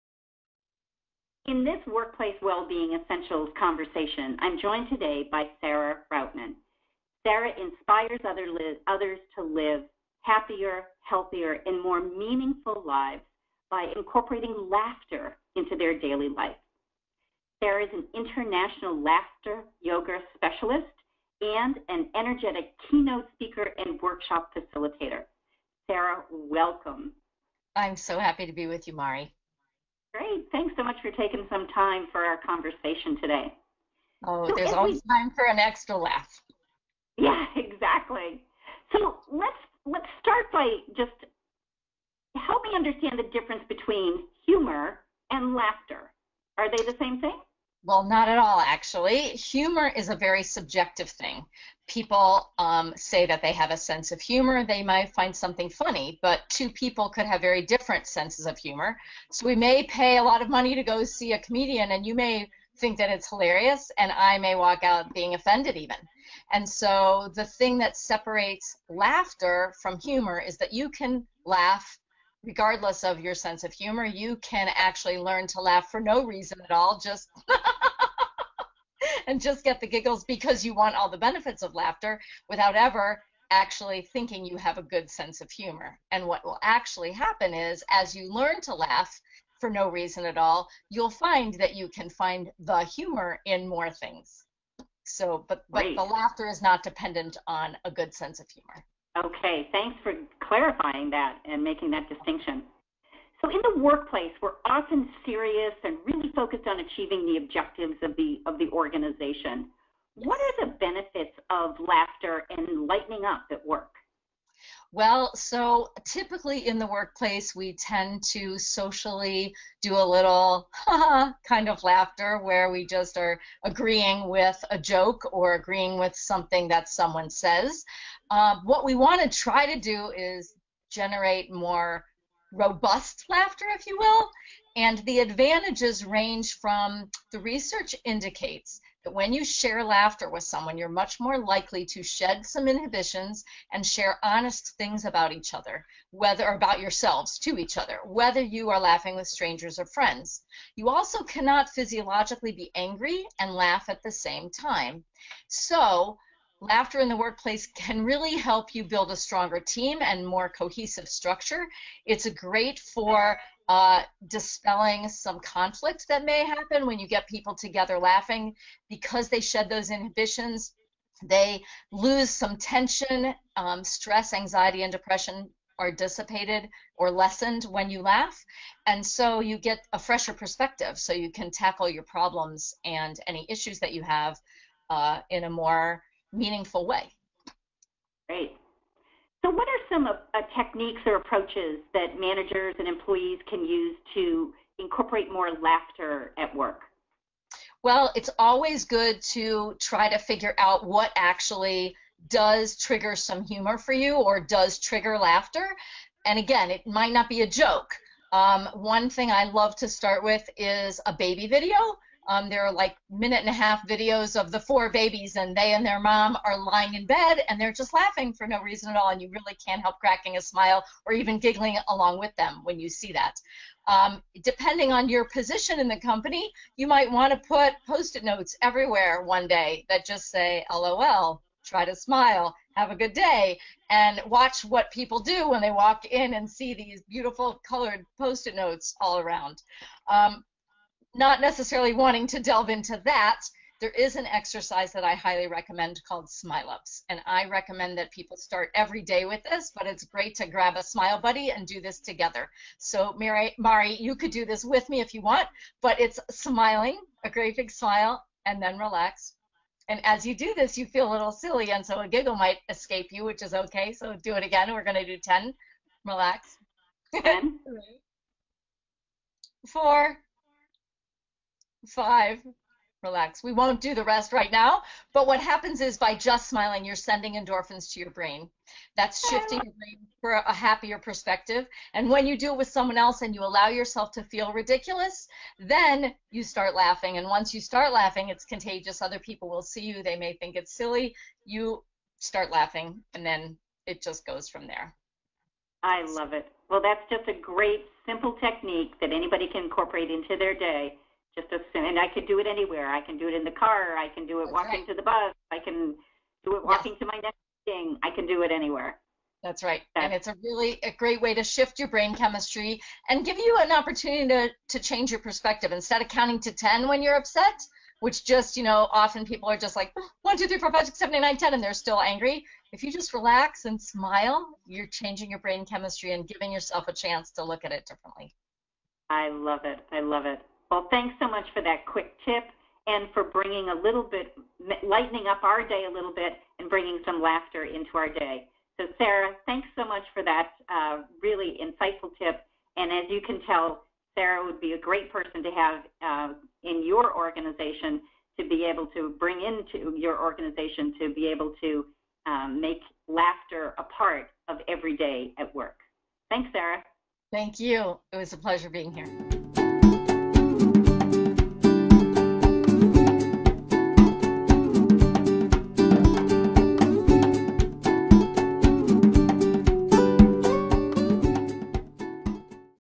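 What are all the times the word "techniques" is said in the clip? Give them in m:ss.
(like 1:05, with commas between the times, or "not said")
3:10, 4:58.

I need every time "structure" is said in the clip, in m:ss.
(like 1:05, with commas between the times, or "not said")
2:41.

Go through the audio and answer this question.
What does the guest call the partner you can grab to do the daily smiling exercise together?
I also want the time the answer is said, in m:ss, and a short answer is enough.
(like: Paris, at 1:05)
Smile buddy, at 4:10.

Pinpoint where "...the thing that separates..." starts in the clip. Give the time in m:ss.
1:07.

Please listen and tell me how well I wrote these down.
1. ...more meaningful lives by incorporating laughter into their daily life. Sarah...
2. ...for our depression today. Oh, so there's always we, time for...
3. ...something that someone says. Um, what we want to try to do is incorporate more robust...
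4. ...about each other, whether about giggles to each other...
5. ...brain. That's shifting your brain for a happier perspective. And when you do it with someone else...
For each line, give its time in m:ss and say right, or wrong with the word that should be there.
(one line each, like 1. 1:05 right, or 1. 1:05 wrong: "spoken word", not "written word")
1. 0:11 right
2. 0:32 wrong: "conversation", not "depression"
3. 2:06 wrong: "generate", not "incorporate"
4. 2:25 wrong: "yourselves", not "giggles"
5. 4:38 right.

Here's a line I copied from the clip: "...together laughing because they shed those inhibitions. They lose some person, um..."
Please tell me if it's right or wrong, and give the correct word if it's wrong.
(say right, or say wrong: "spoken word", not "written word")
wrong: "tension", not "person".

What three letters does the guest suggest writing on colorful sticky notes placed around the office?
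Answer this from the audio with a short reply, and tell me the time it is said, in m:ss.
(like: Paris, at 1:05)
LOL, at 3:50.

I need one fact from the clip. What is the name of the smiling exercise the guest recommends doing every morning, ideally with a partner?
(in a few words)
Smile Ups.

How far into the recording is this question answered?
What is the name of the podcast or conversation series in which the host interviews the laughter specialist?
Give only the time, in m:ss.
0:01.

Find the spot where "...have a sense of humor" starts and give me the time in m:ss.
0:53.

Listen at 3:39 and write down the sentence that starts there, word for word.
And you really can't help cracking a smile or even giggling along with them when you see that.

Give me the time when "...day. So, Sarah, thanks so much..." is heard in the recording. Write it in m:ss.
5:38.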